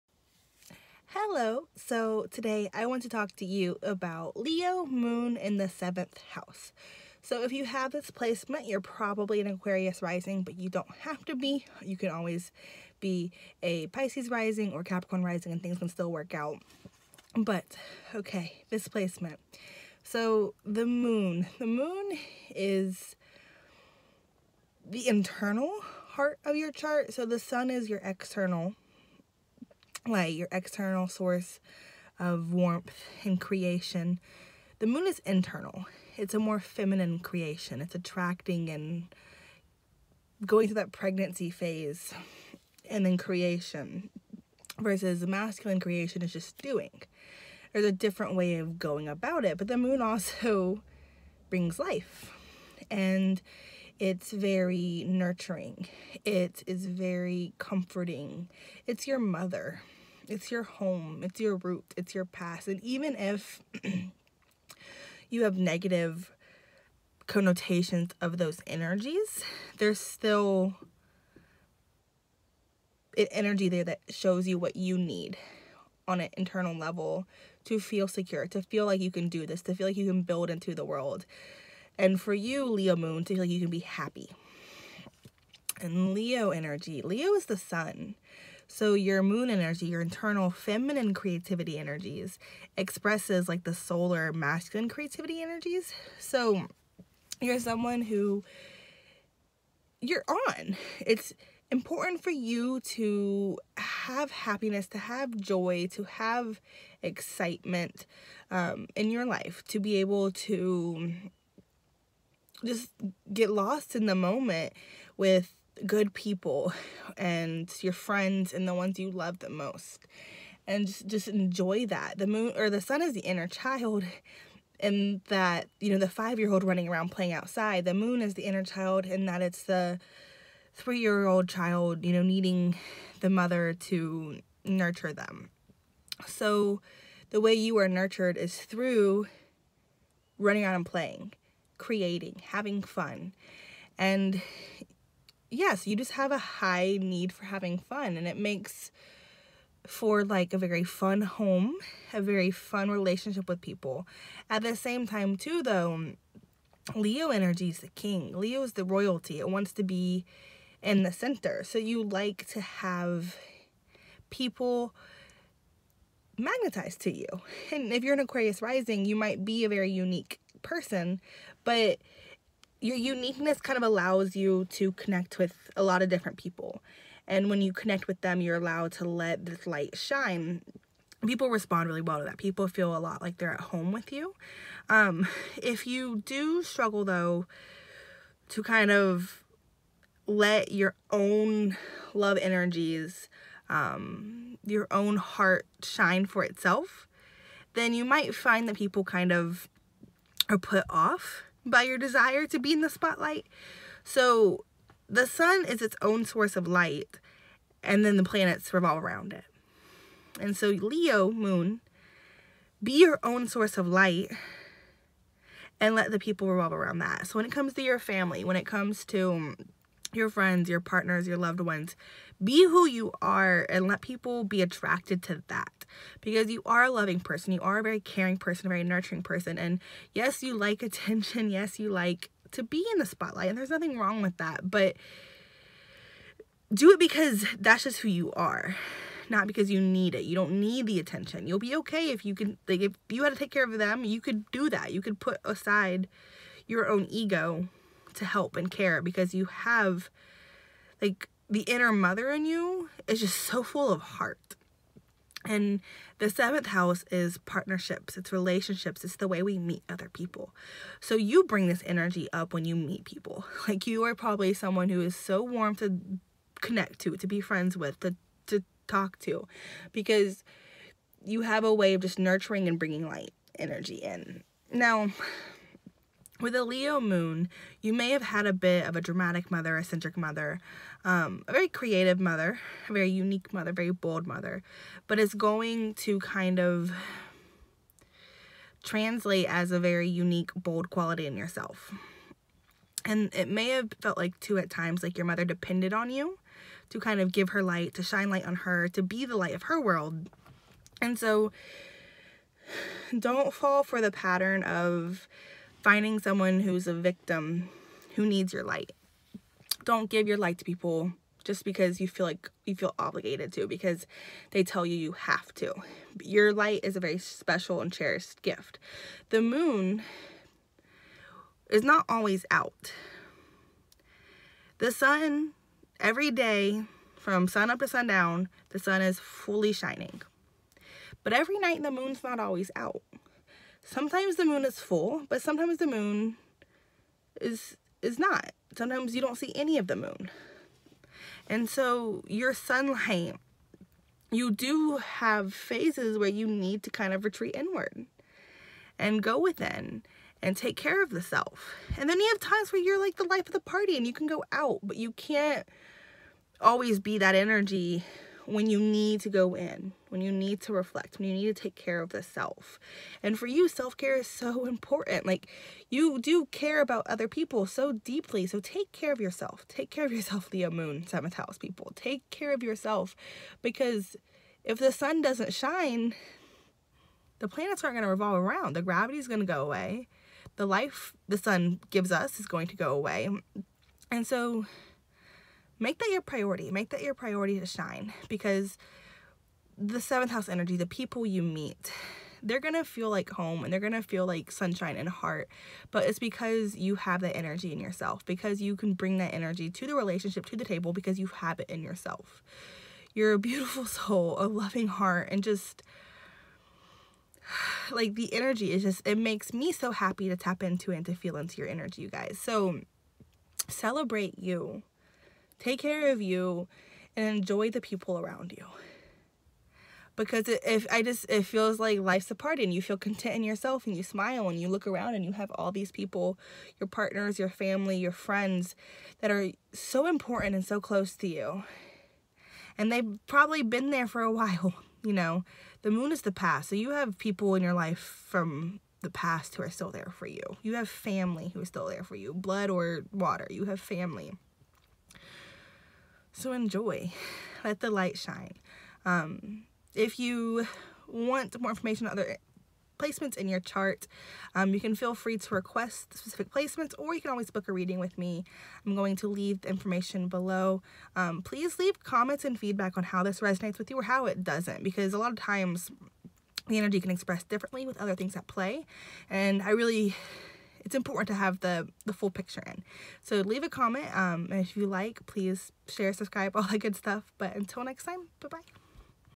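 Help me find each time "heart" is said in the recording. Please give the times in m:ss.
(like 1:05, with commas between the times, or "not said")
0:26, 3:15, 4:14, 6:35, 6:44.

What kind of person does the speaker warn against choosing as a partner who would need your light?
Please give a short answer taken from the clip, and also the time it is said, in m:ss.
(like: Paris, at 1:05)
a victim, at 5:06.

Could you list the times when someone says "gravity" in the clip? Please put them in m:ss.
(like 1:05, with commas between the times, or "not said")
6:18.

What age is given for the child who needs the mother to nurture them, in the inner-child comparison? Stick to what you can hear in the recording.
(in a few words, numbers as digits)
3.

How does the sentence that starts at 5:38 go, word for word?
Sometimes you don't see any of the moon.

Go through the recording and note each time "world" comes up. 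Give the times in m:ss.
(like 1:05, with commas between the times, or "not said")
1:20, 4:59.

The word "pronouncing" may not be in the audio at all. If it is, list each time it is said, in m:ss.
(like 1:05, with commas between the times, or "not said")
not said.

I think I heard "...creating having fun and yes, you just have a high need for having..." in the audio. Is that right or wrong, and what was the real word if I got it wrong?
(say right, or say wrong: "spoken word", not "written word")
right.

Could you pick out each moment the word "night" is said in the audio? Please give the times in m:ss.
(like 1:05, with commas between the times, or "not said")
5:31.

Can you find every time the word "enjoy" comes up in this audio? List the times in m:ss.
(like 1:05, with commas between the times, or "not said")
2:01, 6:57, 7:26.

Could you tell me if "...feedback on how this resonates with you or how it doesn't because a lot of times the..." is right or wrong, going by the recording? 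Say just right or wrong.
right.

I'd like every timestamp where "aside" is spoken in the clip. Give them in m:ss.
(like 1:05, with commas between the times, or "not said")
4:05.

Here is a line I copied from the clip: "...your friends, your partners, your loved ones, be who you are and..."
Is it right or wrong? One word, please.
right.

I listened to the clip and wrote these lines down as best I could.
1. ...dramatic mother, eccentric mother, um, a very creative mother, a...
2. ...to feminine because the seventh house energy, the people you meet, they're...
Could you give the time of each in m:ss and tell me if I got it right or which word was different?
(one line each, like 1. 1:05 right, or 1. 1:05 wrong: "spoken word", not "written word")
1. 4:39 right
2. 6:27 wrong: "shine", not "feminine".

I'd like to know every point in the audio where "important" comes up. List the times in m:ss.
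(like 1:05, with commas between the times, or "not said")
1:41, 6:04, 7:10, 7:50.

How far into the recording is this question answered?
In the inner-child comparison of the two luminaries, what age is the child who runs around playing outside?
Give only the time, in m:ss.
2:06.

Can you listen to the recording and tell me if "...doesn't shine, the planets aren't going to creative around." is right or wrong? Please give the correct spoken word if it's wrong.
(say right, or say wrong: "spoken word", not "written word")
wrong: "revolve", not "creative".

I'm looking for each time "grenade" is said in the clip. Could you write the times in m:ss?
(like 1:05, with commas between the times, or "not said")
not said.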